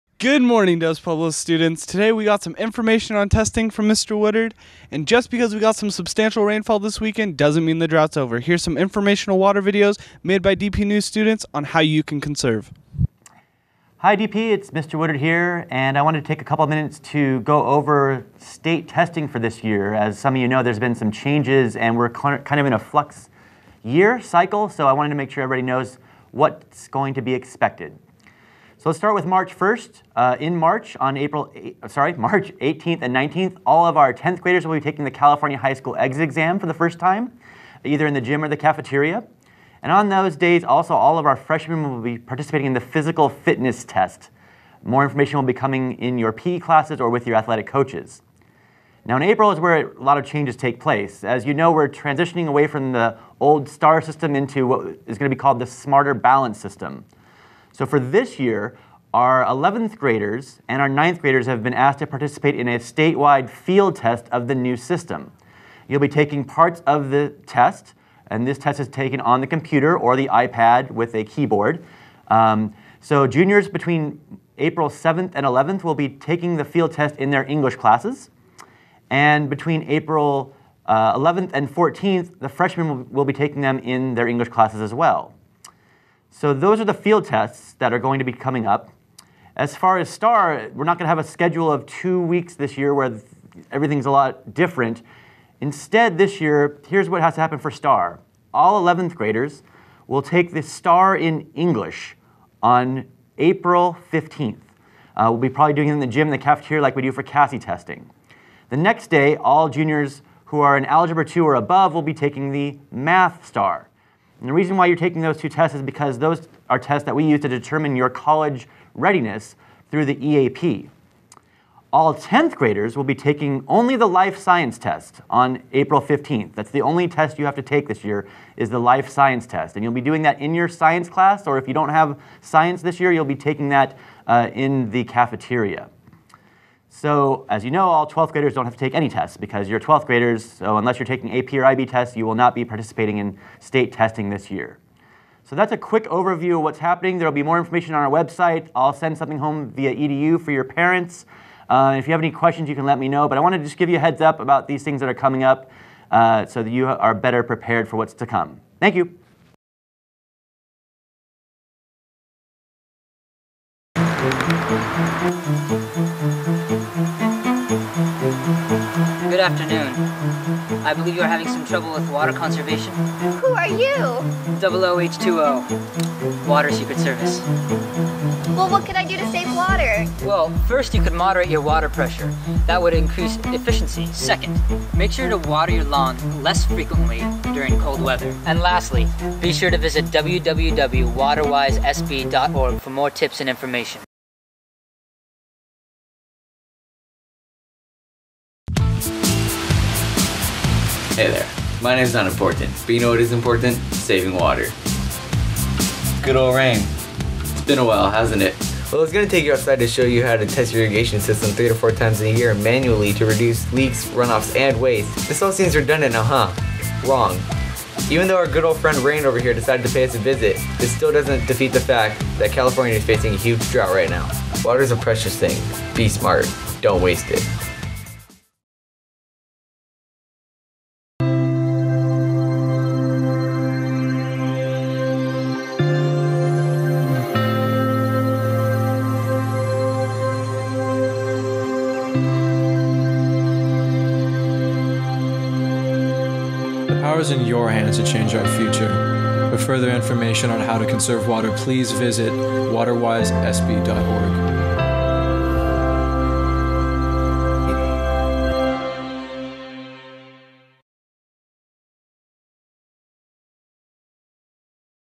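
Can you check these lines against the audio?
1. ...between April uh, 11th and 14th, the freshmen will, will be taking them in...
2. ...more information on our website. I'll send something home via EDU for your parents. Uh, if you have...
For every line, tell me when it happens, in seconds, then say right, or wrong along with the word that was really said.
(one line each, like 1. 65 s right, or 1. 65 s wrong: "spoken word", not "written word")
1. 79 s right
2. 147 s right.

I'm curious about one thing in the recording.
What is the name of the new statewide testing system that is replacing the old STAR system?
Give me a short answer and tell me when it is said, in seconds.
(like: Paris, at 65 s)
Smarter Balance, at 55 s.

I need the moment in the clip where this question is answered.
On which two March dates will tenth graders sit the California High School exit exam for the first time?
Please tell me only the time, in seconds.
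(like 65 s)
32 s.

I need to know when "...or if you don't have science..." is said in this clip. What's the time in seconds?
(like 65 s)
131 s.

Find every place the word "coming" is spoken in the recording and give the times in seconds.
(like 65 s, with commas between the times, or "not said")
45 s, 88 s, 155 s.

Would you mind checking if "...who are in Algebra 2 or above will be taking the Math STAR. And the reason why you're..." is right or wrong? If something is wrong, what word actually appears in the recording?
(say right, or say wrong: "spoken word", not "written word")
right.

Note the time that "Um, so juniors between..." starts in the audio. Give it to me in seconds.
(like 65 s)
72 s.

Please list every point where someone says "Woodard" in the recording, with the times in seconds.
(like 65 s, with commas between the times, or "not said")
4 s, 14 s.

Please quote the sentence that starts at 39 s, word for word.
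And on those days, also all of our freshmen will be participating in the physical fitness test.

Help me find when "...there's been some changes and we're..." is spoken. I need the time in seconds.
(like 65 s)
20 s.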